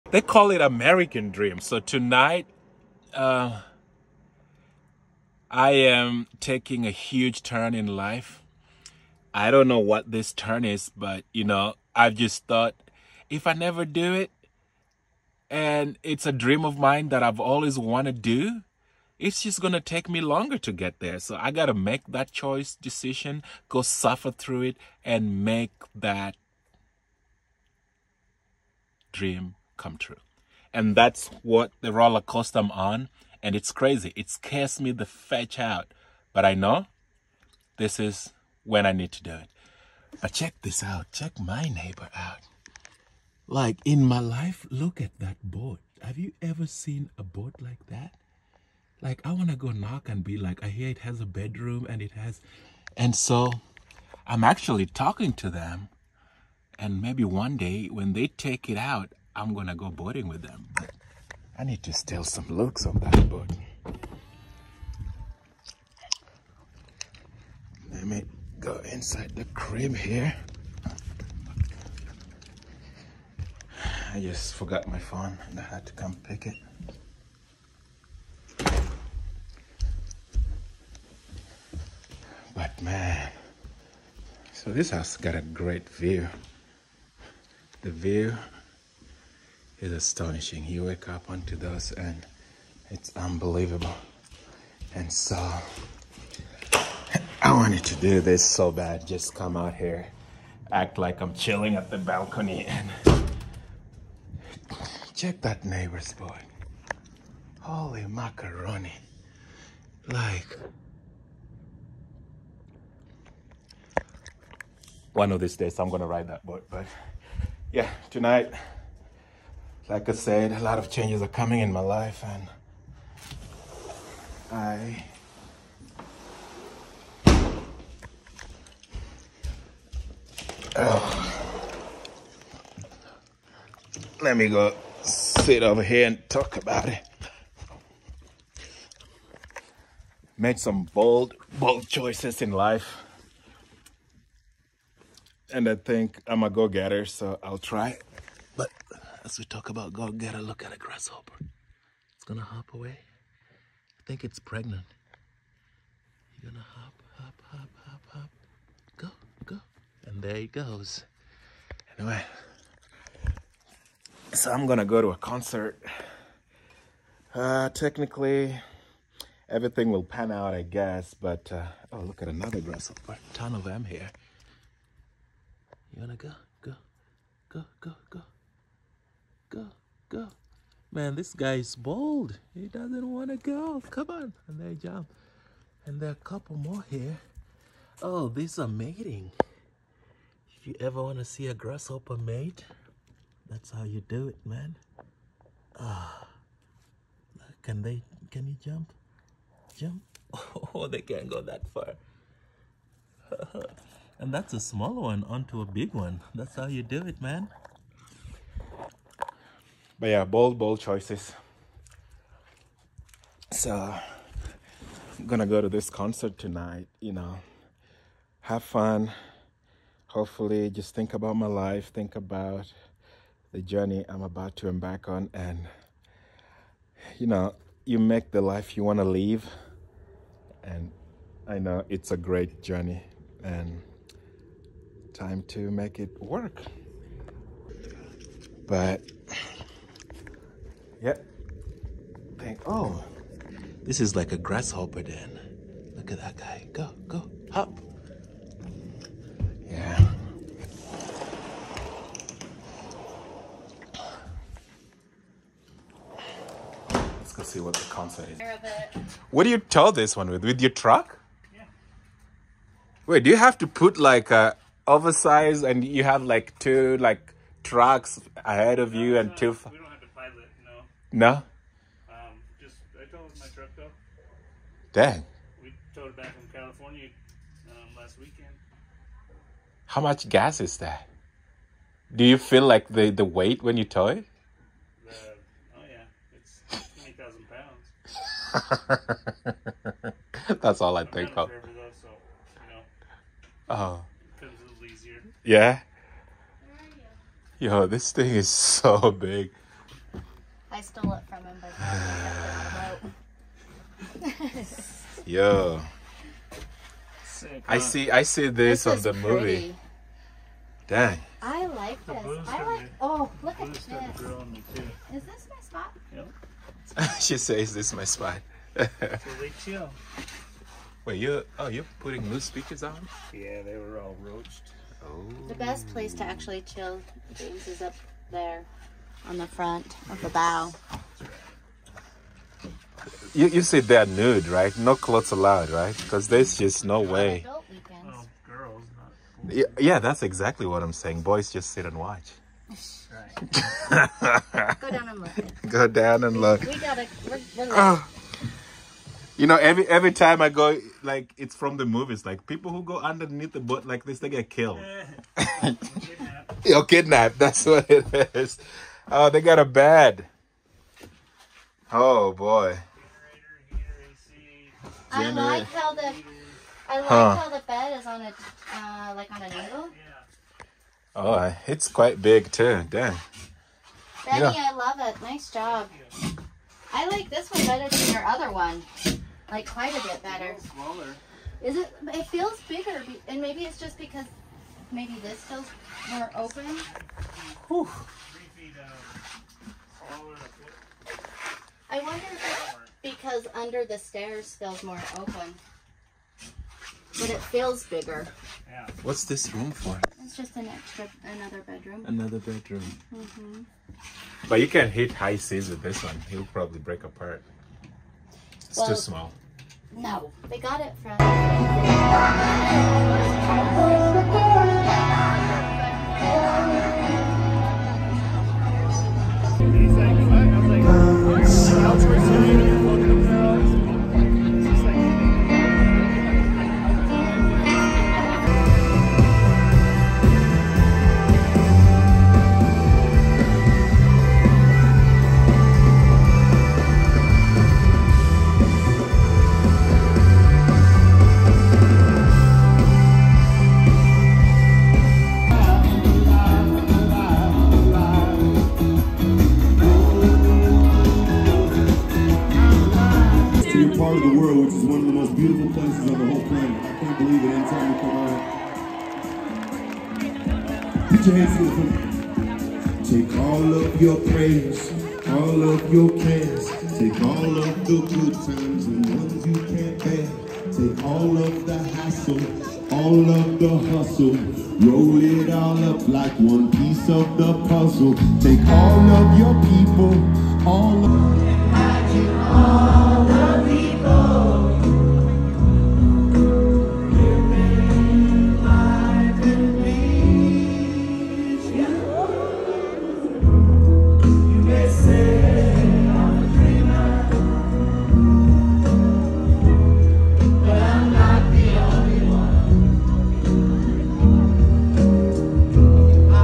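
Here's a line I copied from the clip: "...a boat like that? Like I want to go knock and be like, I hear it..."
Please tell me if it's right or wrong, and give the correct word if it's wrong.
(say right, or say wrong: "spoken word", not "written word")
right.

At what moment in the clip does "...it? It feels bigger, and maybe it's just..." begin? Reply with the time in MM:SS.
06:21.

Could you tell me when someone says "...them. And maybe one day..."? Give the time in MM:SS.
00:55.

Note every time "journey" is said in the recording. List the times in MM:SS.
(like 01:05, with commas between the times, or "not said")
03:43, 03:52.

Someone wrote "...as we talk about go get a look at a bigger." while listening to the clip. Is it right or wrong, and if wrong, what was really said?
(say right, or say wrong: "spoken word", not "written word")
wrong: "grasshopper", not "bigger".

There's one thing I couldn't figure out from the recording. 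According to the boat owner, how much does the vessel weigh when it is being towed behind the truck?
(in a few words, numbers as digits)
20,000 pounds.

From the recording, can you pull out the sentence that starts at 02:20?
Made some bold, bold choices in life.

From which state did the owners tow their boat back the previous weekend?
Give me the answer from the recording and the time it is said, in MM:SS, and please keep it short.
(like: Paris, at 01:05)
California, at 04:36.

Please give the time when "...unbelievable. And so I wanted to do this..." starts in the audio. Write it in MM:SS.
01:33.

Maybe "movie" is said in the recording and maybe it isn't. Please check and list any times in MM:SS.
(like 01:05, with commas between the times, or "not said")
05:09, 05:51.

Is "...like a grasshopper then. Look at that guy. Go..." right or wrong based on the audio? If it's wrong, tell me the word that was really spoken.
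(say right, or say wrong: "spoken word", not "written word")
right.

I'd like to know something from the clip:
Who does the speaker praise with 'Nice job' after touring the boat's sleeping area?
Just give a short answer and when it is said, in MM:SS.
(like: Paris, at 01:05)
Benny, at 06:14.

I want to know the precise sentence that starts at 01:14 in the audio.
I just forgot my phone and I had to come pick it.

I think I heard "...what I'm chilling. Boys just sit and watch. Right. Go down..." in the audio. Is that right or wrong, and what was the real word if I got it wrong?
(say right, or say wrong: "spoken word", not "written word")
wrong: "saying", not "chilling".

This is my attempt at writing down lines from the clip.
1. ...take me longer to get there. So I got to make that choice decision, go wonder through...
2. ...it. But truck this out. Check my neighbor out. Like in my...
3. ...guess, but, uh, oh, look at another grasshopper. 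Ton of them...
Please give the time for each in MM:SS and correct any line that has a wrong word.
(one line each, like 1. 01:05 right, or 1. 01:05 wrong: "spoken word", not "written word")
1. 00:19 wrong: "suffer", not "wonder"
2. 00:39 wrong: "check", not "truck"
3. 02:50 right.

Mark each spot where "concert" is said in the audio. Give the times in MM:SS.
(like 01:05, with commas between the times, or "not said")
02:45, 03:35, 04:17.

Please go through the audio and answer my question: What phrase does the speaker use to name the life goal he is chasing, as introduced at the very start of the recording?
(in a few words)
American Dream.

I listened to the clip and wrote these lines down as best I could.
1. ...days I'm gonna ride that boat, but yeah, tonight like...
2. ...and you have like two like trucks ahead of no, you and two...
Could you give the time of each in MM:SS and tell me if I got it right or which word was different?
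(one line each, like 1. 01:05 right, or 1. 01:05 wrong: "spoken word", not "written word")
1. 01:55 right
2. 04:25 right.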